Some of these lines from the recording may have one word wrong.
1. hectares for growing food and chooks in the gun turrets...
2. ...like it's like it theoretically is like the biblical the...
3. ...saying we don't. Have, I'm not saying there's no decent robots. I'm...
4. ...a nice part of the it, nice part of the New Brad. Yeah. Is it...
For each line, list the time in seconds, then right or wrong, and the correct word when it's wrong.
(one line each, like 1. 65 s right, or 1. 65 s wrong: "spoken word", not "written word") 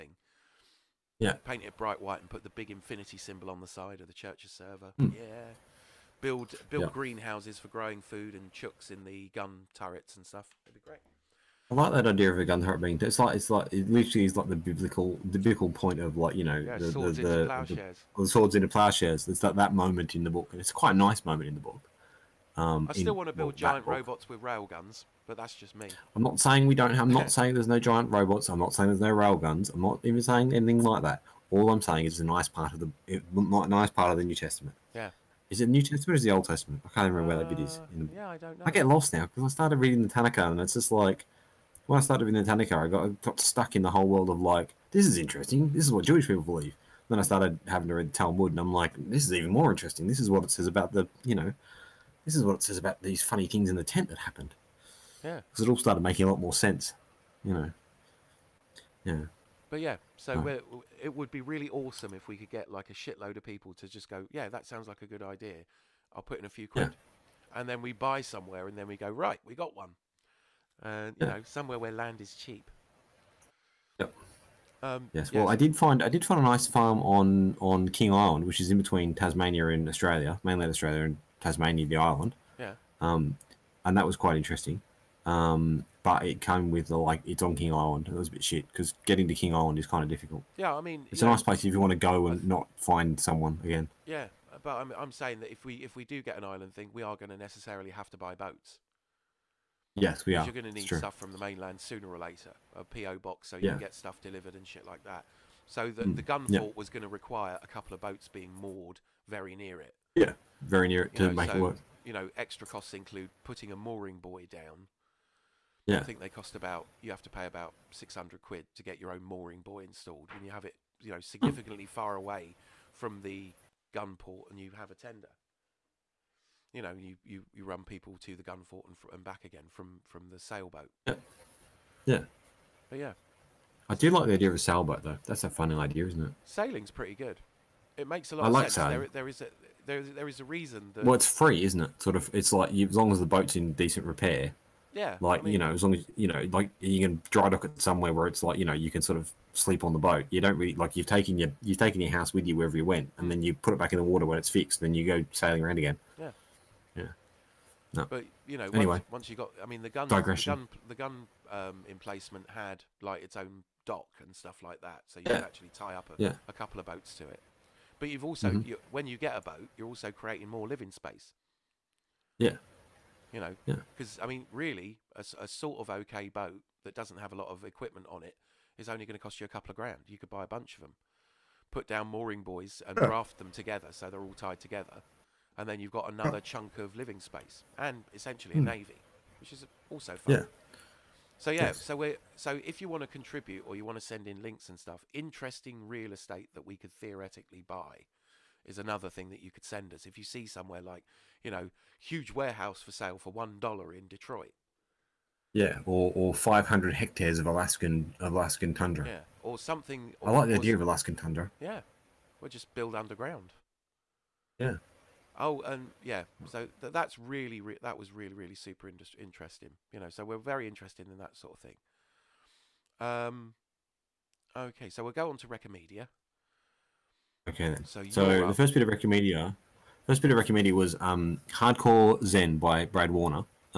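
1. 6 s wrong: "greenhouses", not "hectares"
2. 13 s wrong: "literally", not "theoretically"
3. 26 s wrong: "giant", not "decent"
4. 32 s wrong: "Testament", not "Brad".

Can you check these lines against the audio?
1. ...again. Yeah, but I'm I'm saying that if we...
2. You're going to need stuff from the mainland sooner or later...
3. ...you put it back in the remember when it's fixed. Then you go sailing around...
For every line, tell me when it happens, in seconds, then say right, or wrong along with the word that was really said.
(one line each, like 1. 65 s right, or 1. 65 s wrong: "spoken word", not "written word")
1. 93 s right
2. 100 s right
3. 153 s wrong: "water", not "remember".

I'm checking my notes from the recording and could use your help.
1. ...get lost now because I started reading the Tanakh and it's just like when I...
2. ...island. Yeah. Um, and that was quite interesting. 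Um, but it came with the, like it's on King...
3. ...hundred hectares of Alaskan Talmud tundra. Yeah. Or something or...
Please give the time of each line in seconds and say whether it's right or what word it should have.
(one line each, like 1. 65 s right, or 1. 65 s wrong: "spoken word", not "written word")
1. 38 s right
2. 81 s right
3. 206 s wrong: "Alaskan", not "Talmud".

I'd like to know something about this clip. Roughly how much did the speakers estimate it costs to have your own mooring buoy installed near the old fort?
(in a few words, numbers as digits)
600 quid.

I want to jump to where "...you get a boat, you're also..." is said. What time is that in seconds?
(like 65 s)
169 s.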